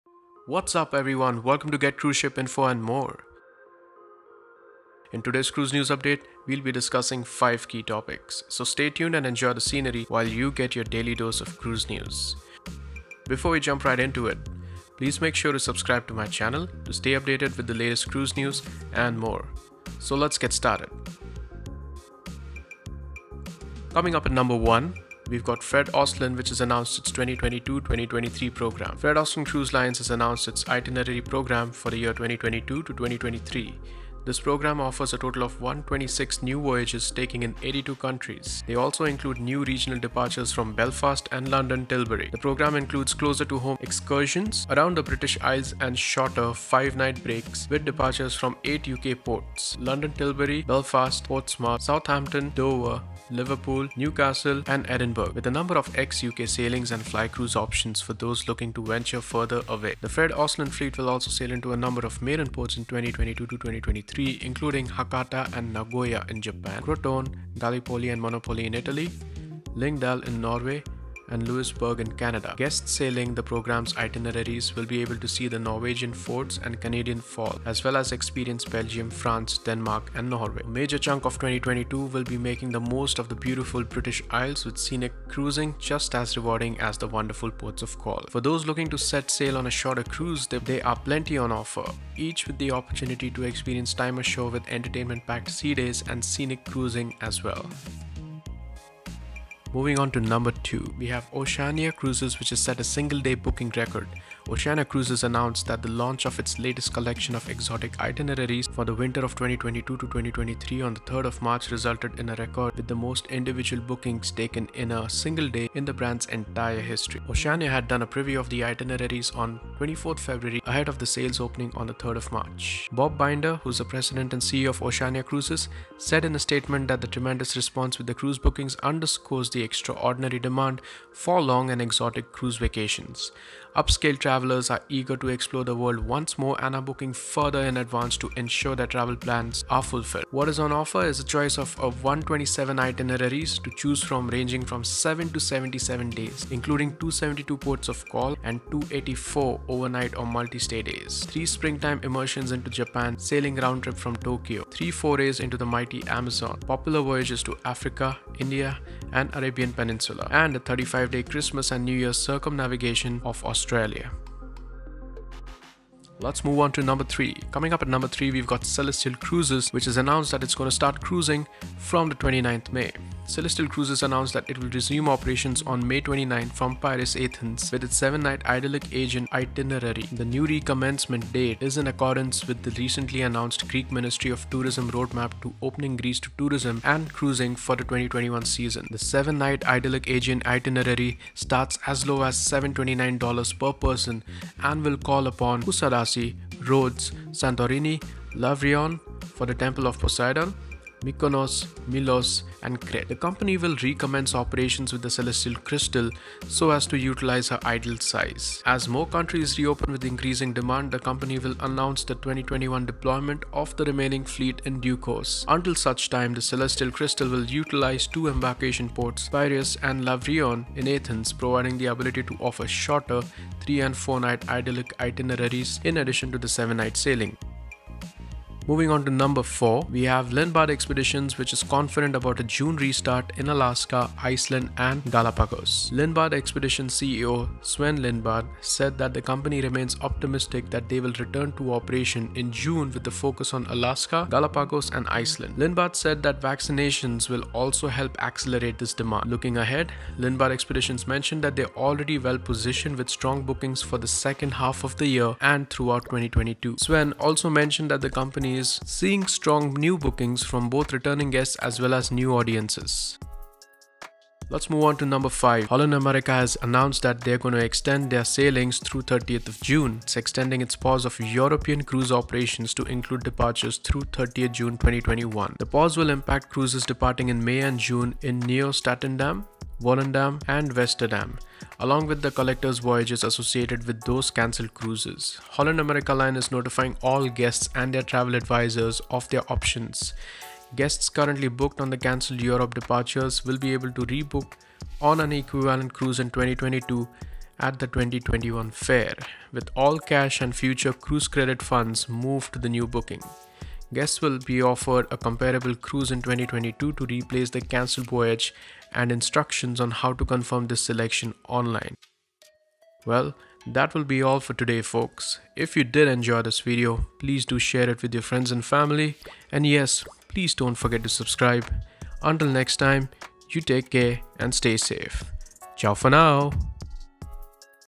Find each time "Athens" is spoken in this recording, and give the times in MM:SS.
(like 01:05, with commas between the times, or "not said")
02:57, 03:40.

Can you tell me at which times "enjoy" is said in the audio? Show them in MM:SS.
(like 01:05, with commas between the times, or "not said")
00:09, 05:16.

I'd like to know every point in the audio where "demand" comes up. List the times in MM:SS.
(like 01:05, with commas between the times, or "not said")
02:10, 03:30, 04:08.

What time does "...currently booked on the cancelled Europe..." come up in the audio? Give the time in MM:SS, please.
04:51.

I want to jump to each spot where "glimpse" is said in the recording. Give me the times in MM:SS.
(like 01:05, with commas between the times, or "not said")
not said.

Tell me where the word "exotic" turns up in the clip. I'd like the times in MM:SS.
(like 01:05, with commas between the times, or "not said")
01:47, 02:11.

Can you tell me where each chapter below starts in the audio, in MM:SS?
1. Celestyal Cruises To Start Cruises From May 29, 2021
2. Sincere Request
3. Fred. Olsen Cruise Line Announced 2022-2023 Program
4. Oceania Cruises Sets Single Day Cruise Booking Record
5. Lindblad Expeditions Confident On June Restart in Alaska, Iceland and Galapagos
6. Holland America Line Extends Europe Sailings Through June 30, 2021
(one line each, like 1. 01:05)
1. 02:46
2. 05:13
3. 00:24
4. 01:41
5. 03:49
6. 04:25.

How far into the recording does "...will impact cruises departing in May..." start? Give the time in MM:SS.
04:35.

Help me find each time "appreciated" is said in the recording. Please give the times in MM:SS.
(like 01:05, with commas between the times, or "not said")
not said.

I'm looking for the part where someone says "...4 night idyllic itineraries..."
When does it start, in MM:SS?
03:43.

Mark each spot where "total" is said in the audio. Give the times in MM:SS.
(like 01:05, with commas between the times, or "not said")
00:35.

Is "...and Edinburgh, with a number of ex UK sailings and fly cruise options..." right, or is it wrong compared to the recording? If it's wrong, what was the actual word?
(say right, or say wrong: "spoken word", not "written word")
right.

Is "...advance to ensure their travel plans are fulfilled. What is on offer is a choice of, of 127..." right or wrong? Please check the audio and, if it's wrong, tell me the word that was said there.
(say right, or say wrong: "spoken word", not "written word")
right.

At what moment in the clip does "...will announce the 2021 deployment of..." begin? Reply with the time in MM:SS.
03:31.